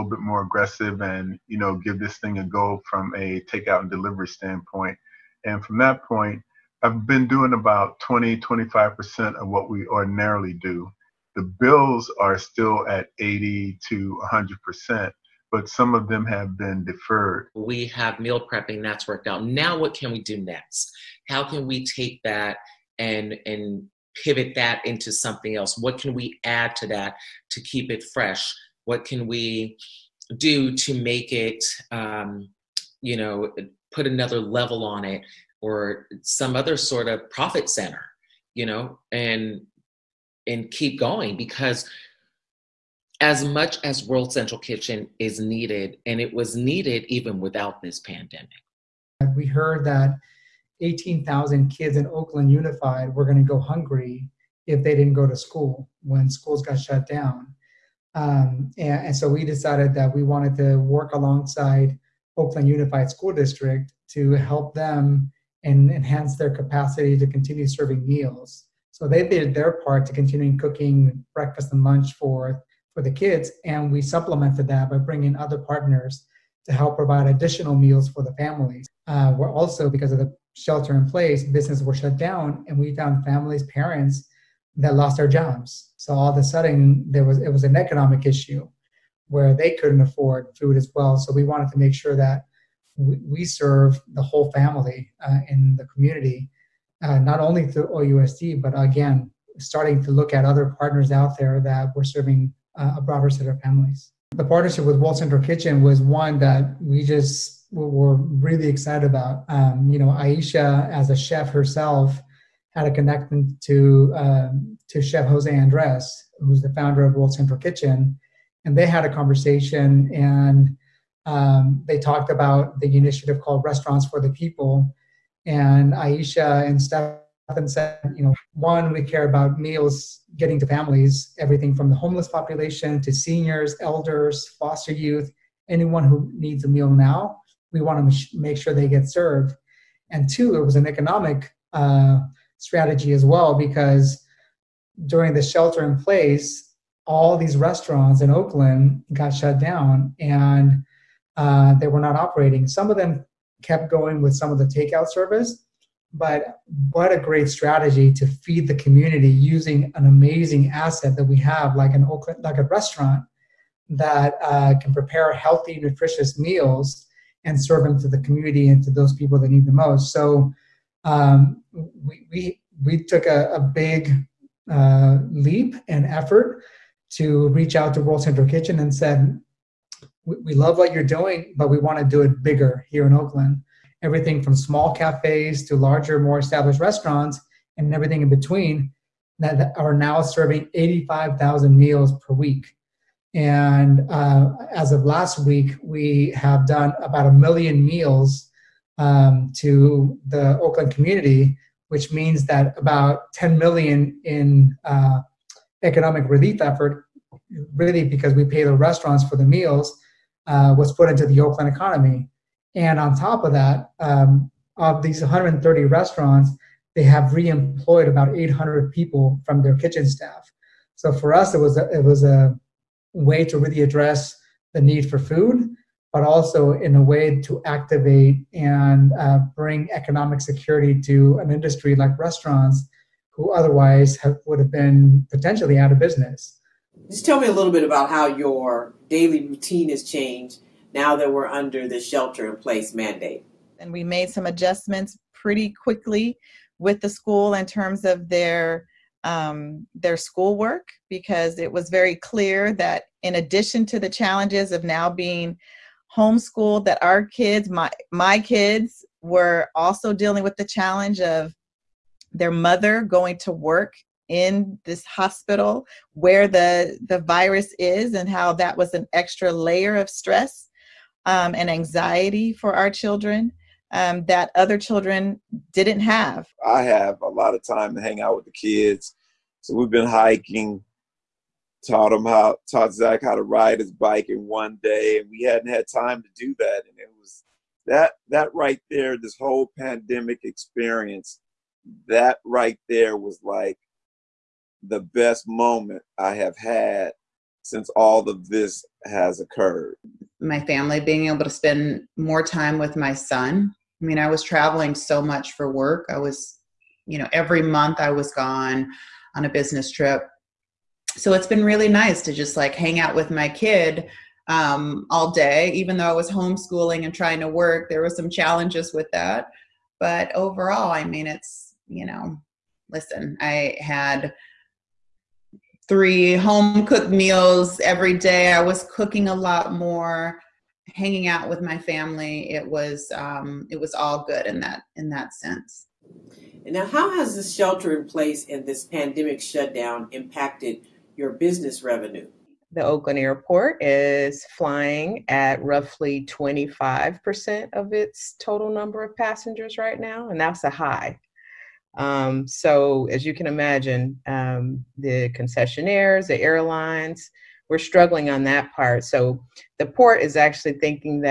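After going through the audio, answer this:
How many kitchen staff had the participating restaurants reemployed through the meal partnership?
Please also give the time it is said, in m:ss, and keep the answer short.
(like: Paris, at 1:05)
800, at 3:38.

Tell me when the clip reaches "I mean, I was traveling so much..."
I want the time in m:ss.
5:04.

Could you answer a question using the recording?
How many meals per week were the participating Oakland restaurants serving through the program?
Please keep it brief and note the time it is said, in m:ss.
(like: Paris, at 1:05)
85,000, at 3:10.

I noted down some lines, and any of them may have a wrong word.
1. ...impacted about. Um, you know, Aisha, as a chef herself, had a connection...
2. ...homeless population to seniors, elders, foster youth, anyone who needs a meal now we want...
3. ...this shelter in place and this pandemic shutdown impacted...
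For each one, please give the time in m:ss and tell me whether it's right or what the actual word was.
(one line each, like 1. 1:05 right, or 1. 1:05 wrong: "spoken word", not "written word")
1. 1:48 wrong: "excited", not "impacted"
2. 2:11 right
3. 5:37 right.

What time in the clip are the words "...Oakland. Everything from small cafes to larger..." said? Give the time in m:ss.
3:03.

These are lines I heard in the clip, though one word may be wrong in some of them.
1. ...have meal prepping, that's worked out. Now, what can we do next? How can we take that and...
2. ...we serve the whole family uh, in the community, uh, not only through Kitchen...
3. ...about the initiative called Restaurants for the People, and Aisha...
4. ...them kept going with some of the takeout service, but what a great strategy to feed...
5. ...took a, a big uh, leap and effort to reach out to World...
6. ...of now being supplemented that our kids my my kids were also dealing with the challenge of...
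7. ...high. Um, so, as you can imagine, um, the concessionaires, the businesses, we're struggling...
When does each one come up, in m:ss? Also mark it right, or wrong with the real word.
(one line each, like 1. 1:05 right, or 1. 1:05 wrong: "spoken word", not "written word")
1. 0:17 right
2. 1:33 wrong: "OUSD", not "Kitchen"
3. 2:02 right
4. 2:32 right
5. 2:53 right
6. 4:14 wrong: "homeschooled", not "supplemented"
7. 5:50 wrong: "airlines", not "businesses".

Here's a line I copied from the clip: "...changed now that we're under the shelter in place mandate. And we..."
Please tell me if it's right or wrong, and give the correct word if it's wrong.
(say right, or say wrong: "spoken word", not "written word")
right.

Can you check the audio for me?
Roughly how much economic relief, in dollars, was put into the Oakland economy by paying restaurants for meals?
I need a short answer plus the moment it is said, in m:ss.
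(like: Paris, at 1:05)
10 million, at 3:23.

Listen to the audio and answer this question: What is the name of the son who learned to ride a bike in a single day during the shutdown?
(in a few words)
Zach.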